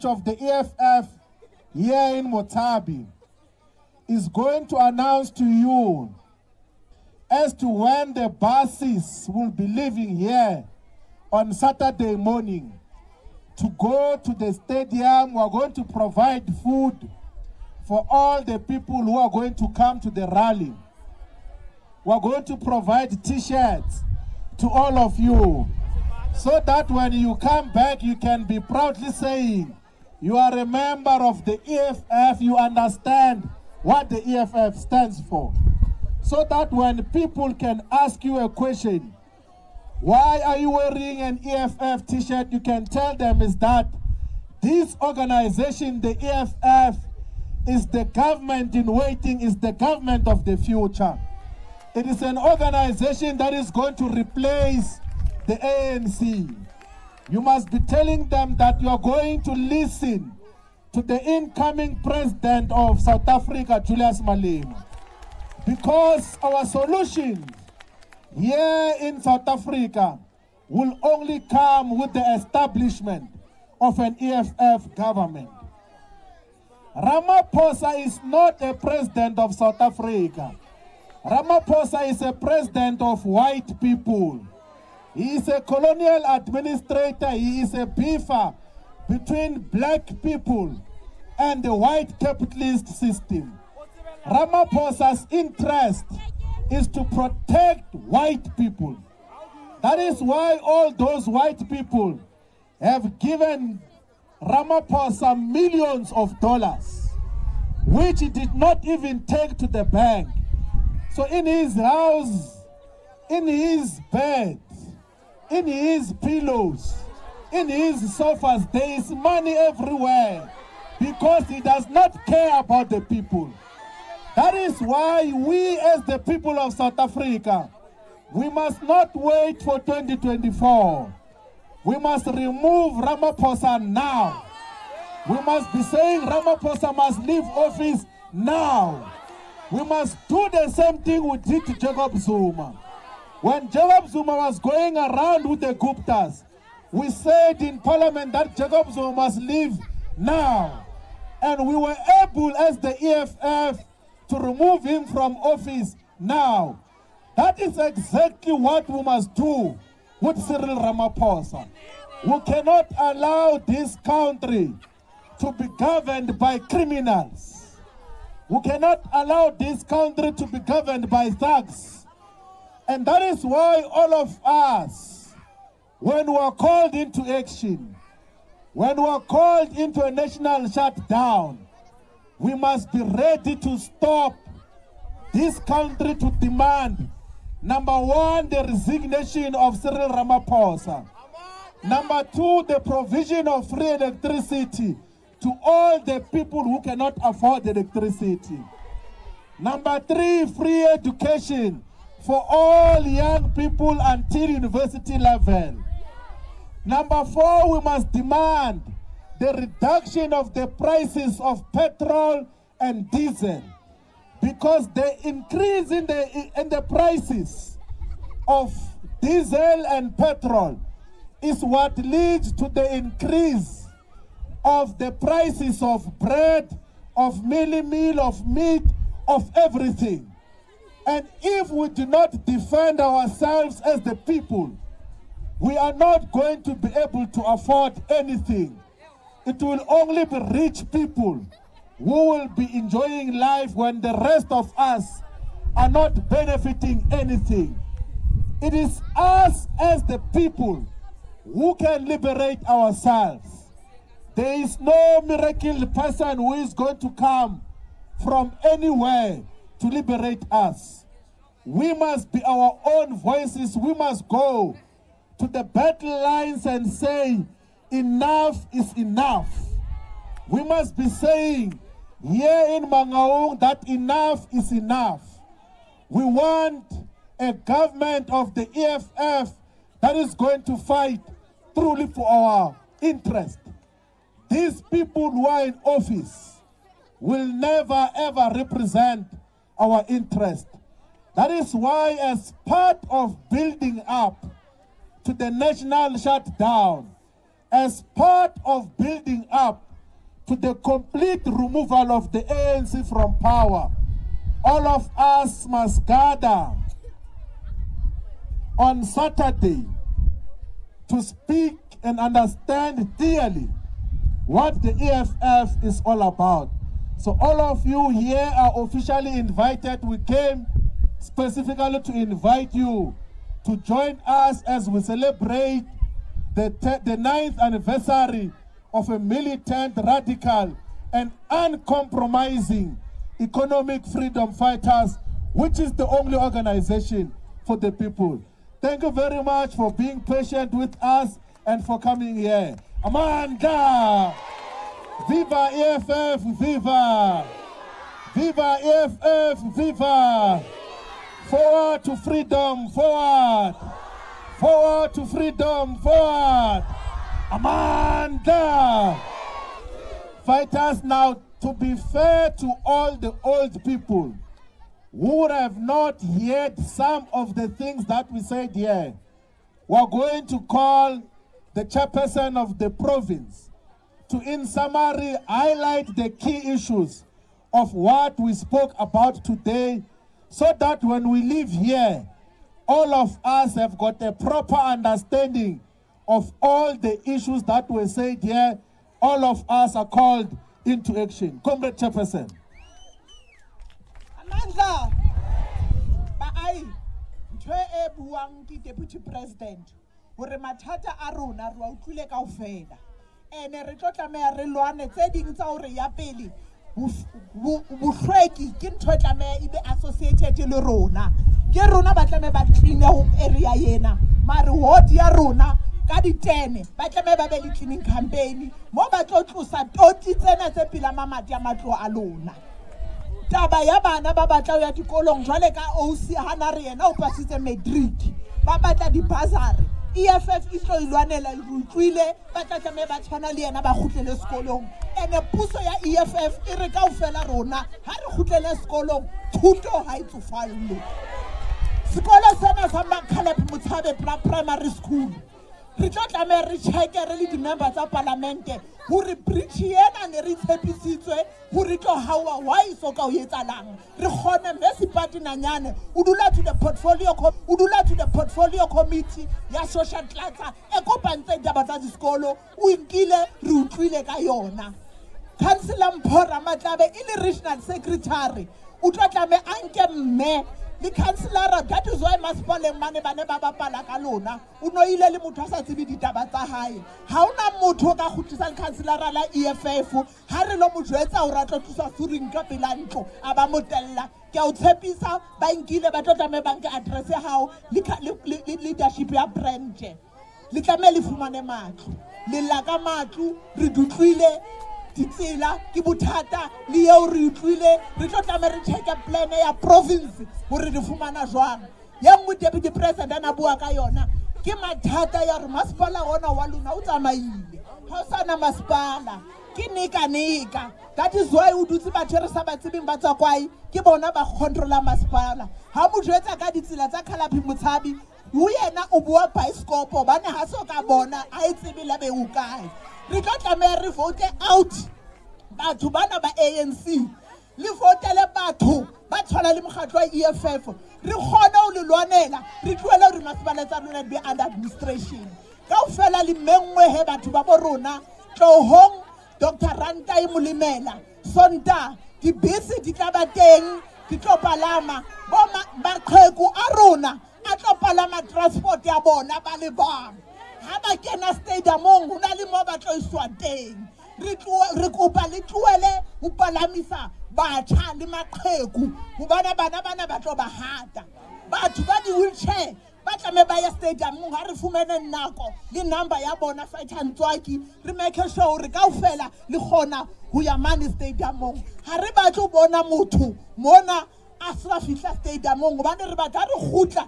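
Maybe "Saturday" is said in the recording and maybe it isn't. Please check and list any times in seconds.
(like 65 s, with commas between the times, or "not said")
11 s, 309 s.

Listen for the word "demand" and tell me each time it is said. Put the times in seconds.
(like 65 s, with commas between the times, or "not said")
186 s, 208 s.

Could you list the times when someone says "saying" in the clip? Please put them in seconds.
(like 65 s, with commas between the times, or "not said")
29 s, 135 s, 271 s.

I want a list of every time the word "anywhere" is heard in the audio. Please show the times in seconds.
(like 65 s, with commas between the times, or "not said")
258 s.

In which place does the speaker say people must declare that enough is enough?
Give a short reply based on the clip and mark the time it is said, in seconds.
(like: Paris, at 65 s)
Mangaung, at 272 s.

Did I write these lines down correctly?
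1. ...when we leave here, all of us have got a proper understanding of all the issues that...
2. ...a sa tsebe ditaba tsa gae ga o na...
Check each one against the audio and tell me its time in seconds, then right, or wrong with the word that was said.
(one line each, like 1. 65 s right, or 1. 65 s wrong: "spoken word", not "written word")
1. 381 s right
2. 475 s right.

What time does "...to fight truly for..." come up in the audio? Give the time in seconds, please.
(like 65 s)
280 s.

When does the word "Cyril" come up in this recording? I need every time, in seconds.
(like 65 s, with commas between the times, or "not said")
160 s, 189 s.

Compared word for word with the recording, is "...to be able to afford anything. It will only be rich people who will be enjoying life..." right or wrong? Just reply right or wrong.
right.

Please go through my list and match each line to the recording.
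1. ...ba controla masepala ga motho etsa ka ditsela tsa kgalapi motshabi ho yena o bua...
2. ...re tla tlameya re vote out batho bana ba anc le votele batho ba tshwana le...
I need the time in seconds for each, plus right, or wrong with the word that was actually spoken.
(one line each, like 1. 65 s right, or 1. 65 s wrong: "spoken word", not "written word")
1. 514 s right
2. 523 s right.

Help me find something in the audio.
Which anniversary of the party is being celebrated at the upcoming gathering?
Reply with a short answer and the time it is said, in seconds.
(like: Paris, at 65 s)
ninth, at 327 s.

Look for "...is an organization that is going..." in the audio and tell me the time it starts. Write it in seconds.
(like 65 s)
52 s.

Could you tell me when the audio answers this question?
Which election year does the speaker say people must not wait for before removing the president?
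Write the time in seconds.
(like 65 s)
129 s.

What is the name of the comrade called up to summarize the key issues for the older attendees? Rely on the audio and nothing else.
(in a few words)
Jefferson.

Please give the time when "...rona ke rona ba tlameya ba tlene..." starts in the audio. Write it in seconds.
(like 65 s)
410 s.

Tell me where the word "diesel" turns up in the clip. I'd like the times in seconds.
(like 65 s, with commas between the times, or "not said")
213 s, 219 s.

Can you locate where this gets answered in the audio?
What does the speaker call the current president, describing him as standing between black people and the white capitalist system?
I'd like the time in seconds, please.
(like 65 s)
85 s.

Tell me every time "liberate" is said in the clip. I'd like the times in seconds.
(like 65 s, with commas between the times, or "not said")
252 s, 259 s.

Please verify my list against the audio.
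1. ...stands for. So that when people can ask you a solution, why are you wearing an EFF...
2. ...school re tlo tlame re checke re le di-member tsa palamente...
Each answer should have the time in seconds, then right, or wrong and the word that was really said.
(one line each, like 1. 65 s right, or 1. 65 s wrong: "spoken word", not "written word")
1. 34 s wrong: "question", not "solution"
2. 444 s right.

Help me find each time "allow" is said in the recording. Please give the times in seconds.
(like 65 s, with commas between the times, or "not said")
162 s, 169 s.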